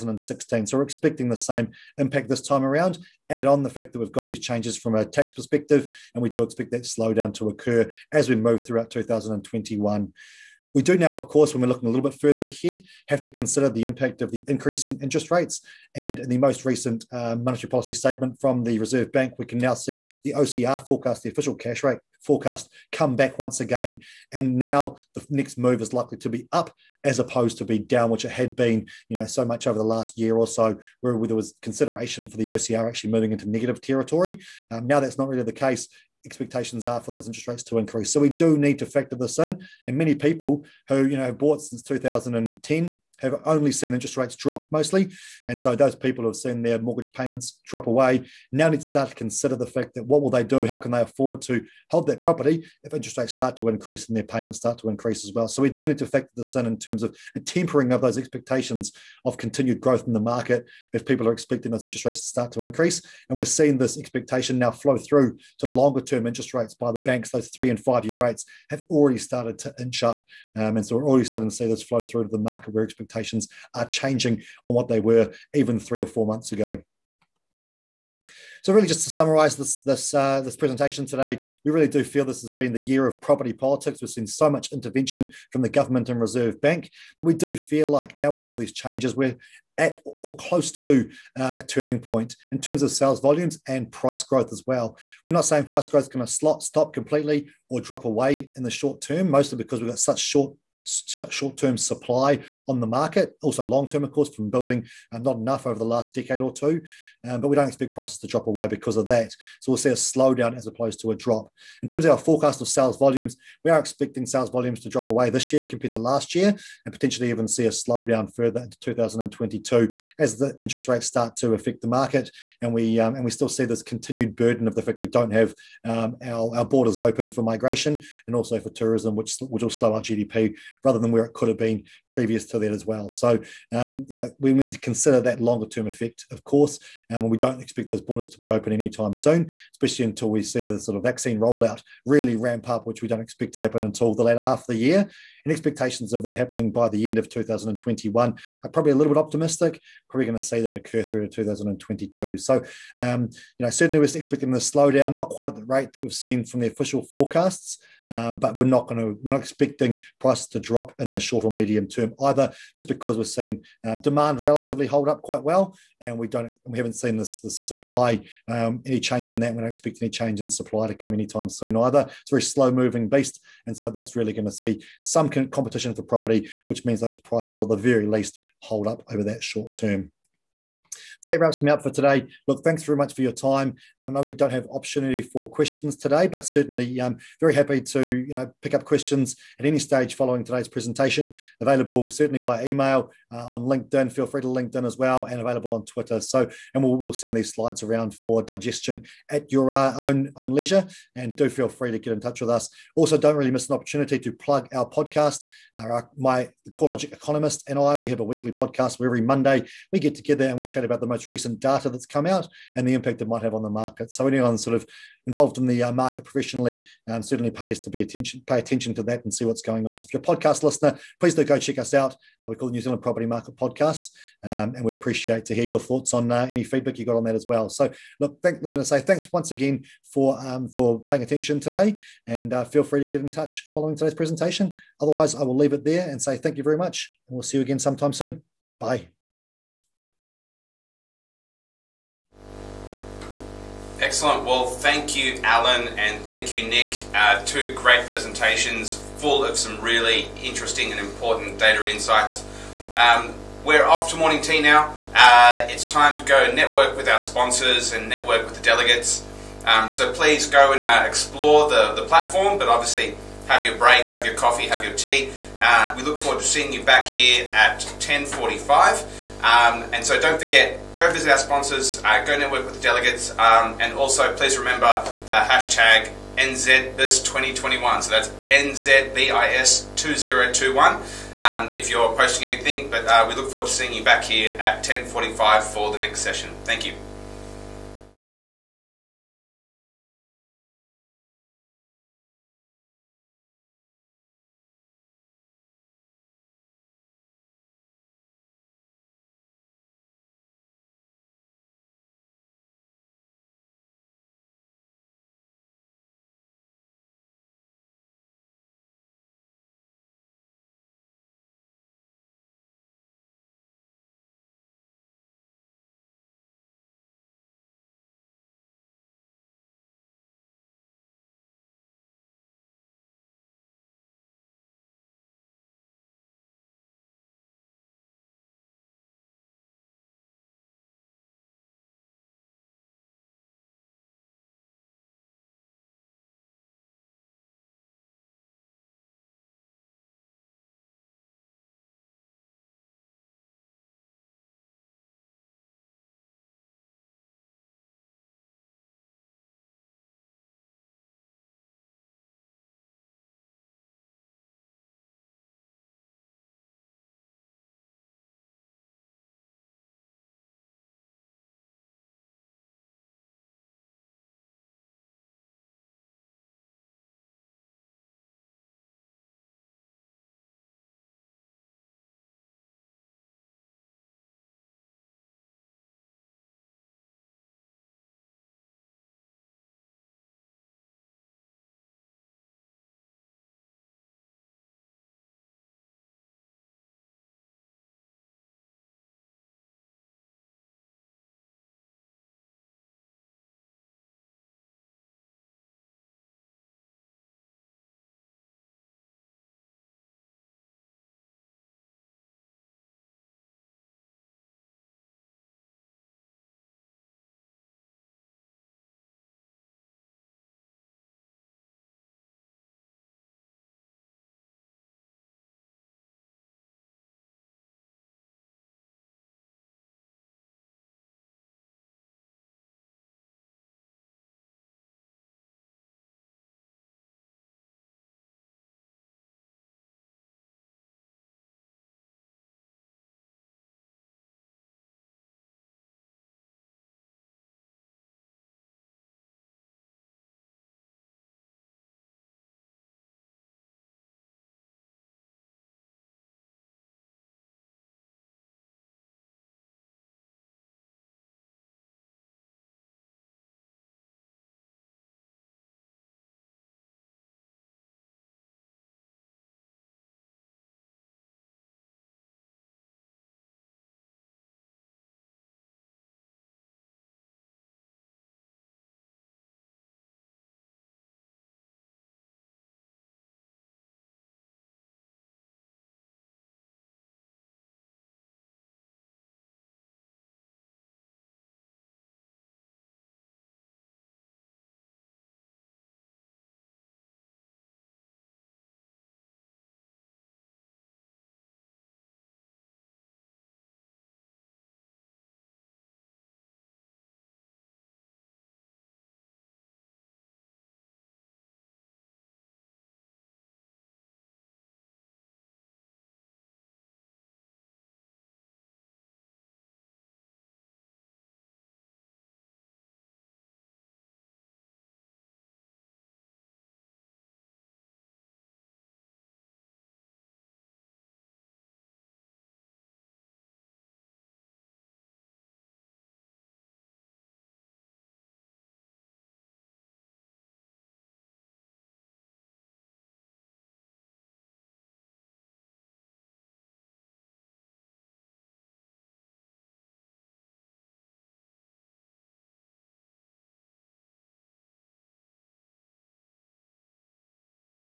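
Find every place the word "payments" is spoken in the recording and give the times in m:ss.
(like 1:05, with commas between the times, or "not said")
0:47, 0:54.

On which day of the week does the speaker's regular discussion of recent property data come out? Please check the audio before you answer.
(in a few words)
Monday.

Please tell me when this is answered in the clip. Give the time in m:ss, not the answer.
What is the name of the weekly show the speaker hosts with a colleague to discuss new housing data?
3:42.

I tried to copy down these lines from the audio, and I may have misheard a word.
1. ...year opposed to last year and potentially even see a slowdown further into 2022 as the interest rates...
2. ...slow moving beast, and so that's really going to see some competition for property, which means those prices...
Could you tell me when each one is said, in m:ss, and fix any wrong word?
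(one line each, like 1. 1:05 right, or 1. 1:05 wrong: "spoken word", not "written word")
1. 1:55 wrong: "compared", not "opposed"
2. 2:52 right.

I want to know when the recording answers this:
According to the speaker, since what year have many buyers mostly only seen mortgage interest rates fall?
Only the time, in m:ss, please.
0:41.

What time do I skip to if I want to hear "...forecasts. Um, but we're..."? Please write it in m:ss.
2:37.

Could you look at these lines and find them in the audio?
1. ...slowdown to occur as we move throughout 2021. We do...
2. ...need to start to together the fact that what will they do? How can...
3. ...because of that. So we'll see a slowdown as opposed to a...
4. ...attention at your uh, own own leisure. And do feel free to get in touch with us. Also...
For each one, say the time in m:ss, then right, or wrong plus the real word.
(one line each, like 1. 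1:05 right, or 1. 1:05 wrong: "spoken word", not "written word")
1. 0:06 right
2. 0:48 wrong: "consider", not "together"
3. 1:48 right
4. 3:18 wrong: "digestion", not "attention".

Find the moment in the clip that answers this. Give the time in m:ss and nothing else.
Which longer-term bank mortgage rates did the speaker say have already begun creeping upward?
1:07.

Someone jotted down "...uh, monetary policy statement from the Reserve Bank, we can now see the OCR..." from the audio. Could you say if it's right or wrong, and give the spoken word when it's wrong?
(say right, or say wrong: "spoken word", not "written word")
right.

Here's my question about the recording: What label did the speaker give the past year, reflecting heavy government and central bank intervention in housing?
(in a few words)
the year of property politics.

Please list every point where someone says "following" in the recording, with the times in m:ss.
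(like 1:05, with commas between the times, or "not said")
3:10, 3:53.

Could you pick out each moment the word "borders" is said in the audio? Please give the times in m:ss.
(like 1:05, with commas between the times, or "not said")
2:06, 2:18.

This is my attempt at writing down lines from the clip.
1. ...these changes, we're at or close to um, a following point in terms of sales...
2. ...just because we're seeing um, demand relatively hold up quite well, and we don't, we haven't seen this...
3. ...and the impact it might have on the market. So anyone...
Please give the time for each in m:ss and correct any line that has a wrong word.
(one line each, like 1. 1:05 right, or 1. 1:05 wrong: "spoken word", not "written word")
1. 1:28 wrong: "turning", not "following"
2. 2:42 right
3. 3:32 right.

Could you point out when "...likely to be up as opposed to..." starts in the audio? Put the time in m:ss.
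0:25.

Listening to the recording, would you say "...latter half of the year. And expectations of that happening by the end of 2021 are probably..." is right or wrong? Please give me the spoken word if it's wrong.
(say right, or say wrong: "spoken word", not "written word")
right.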